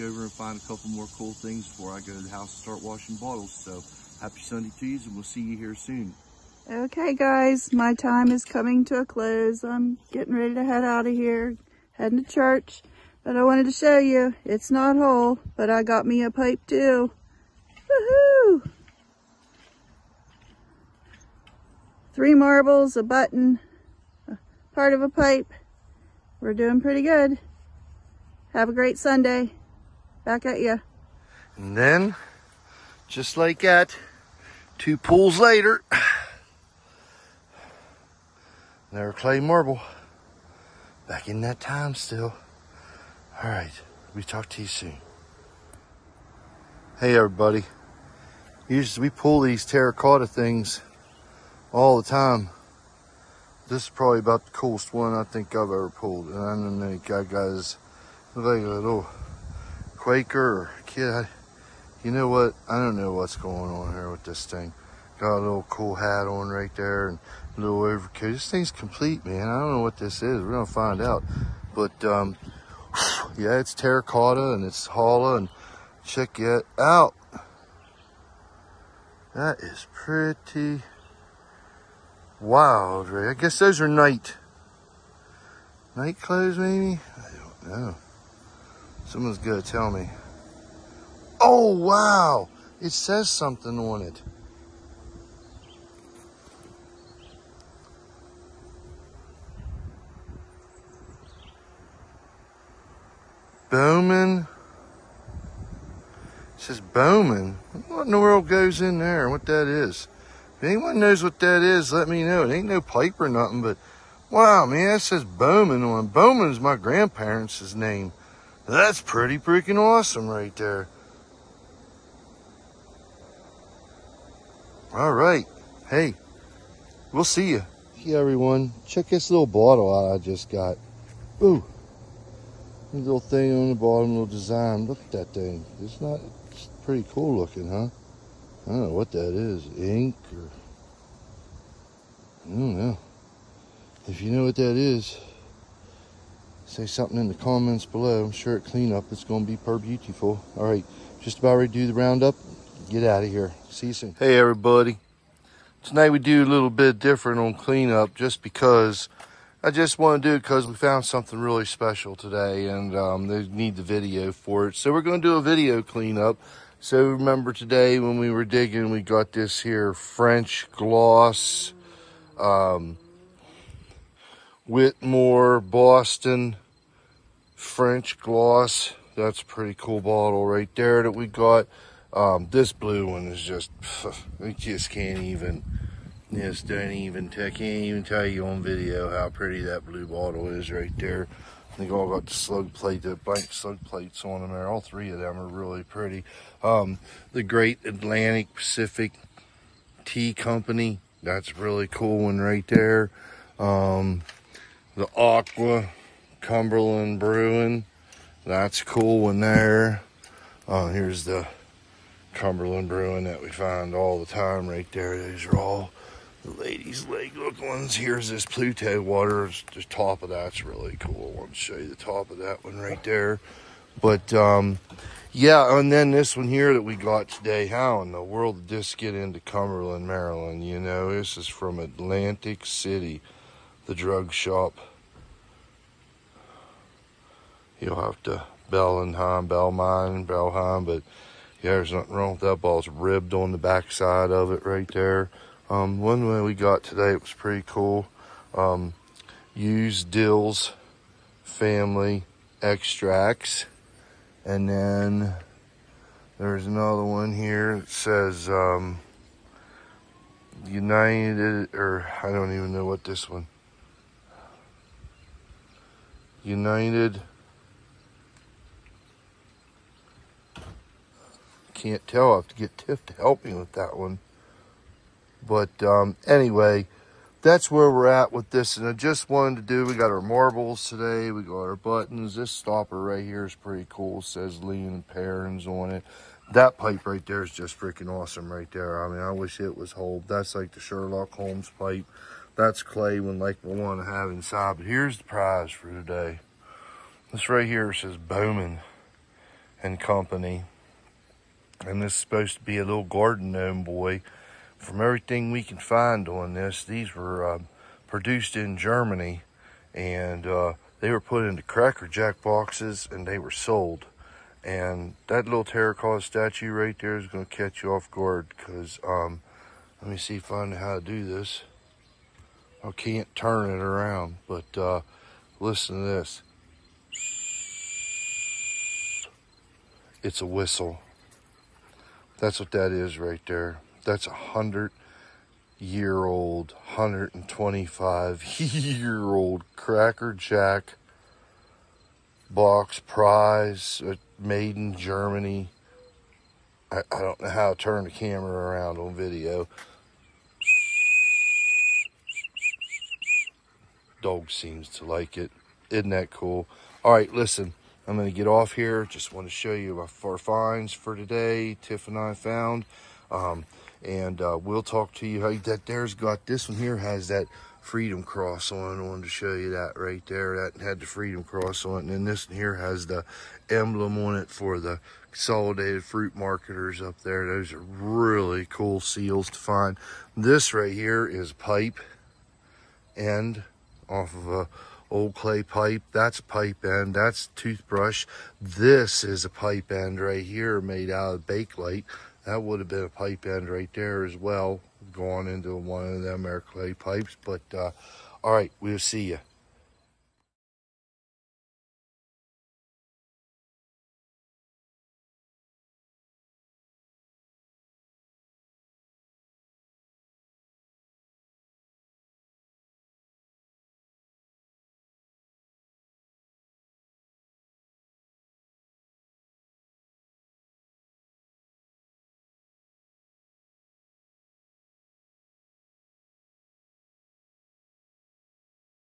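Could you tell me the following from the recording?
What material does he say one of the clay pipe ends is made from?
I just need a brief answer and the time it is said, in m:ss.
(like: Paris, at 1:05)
Bakelite, at 6:31.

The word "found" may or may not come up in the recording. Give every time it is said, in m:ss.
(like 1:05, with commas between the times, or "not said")
2:40, 6:02.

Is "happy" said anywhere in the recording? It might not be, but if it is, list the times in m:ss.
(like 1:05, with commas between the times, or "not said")
0:04.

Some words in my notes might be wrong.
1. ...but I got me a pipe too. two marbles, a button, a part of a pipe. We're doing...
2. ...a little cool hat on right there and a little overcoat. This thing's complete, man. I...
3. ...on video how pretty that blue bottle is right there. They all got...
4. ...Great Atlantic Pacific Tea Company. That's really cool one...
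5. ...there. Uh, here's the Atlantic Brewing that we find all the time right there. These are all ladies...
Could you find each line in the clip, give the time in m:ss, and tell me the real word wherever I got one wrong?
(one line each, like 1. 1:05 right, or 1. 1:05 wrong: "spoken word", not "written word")
1. 0:15 wrong: "three", not "two"
2. 1:05 right
3. 3:08 right
4. 3:17 right
5. 3:29 wrong: "Cumberland", not "Atlantic".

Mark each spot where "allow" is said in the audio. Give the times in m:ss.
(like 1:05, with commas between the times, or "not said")
not said.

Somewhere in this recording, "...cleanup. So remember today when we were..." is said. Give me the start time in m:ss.
2:45.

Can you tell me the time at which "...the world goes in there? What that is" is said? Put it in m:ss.
1:48.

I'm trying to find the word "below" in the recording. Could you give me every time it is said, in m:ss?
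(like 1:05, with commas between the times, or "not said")
2:27.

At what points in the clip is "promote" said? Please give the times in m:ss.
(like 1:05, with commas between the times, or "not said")
not said.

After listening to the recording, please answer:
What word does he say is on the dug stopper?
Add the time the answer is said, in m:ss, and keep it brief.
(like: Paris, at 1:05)
Lean, at 4:44.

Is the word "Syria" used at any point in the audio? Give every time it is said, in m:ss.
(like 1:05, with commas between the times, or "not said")
not said.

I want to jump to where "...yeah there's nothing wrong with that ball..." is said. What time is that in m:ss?
4:01.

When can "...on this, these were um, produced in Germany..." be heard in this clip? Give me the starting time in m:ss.
5:06.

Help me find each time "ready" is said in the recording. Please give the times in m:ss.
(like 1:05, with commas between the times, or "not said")
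0:10, 2:31.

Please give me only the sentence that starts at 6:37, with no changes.
But, uh, all right, we'll see you.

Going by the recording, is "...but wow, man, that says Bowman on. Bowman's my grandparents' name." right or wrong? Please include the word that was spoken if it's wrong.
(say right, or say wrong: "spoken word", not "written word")
right.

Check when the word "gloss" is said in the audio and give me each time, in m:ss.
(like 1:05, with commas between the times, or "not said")
2:50, 2:58.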